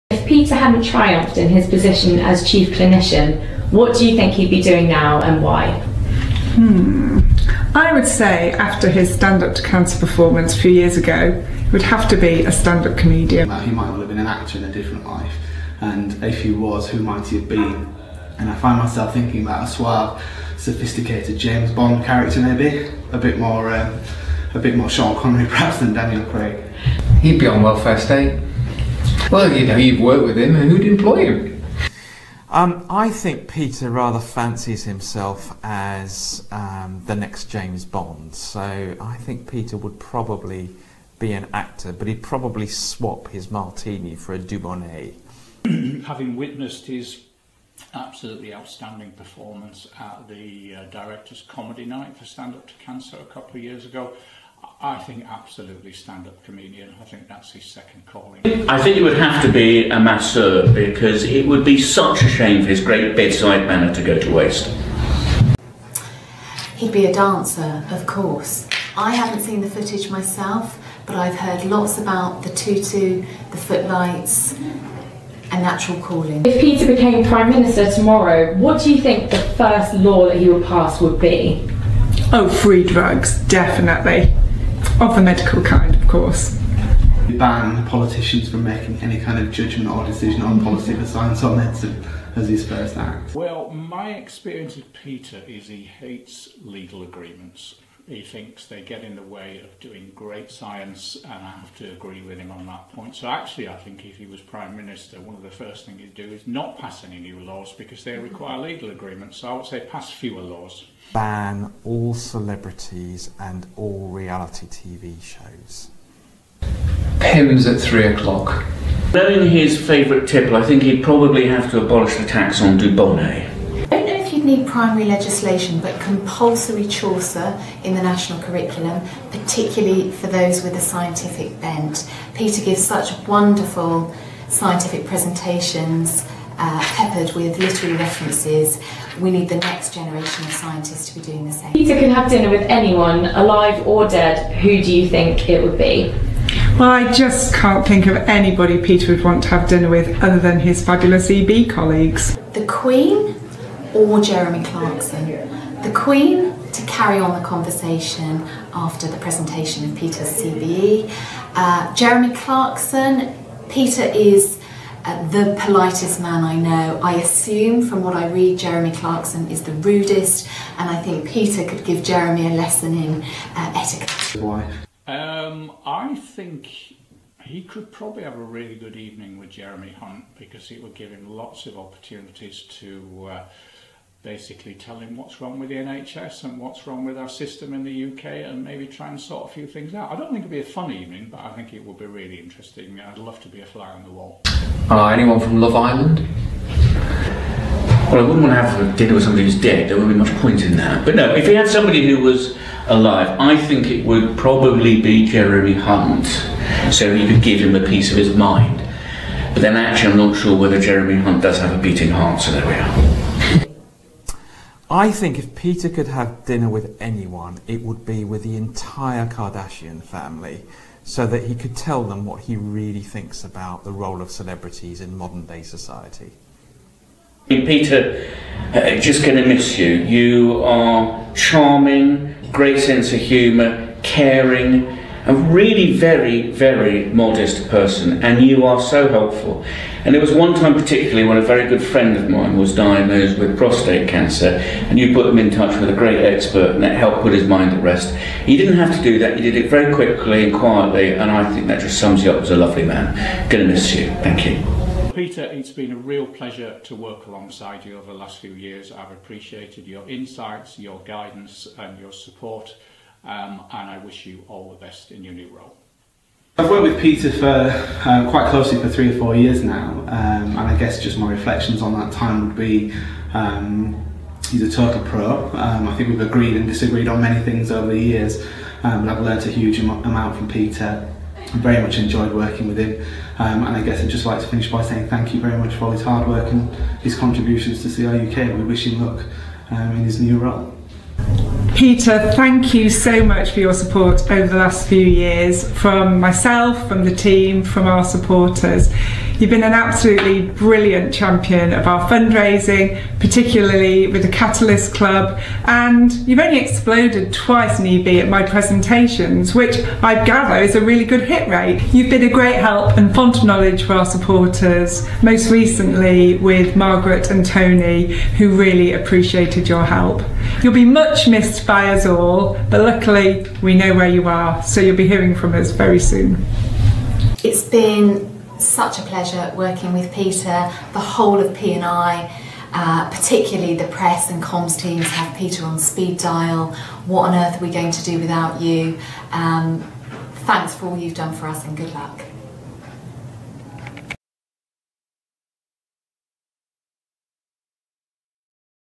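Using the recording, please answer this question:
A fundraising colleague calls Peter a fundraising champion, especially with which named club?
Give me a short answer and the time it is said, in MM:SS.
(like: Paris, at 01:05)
Catalyst Club, at 05:04.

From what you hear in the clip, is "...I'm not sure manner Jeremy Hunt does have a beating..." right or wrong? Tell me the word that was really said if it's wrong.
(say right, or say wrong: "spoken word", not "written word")
wrong: "whether", not "manner".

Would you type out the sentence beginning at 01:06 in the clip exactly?
He'd be a dancer, of course.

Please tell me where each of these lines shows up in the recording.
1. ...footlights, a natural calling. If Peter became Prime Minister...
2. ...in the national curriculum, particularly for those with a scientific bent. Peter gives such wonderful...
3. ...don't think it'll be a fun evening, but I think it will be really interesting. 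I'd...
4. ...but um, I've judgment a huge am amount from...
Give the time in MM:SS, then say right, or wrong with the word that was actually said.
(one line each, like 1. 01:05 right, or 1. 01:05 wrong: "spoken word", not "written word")
1. 01:13 right
2. 02:07 right
3. 03:10 right
4. 04:38 wrong: "learnt", not "judgment".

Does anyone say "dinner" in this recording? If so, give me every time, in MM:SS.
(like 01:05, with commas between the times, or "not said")
02:22, 02:29, 03:18, 03:36.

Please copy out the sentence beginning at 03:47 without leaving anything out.
Peter, uh, just going to miss you.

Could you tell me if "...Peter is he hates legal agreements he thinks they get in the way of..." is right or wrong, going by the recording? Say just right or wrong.
right.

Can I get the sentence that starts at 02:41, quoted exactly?
Uh, Jeremy Clarkson, Peter is uh, the politest man I know.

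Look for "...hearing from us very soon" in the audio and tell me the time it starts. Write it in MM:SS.
05:25.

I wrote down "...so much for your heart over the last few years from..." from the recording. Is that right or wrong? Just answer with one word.
wrong.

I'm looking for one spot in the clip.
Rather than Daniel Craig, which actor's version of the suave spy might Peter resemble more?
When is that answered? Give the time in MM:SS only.
00:24.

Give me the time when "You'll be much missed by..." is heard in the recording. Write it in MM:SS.
05:20.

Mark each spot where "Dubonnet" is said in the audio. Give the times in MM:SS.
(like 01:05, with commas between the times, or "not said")
00:44, 02:02.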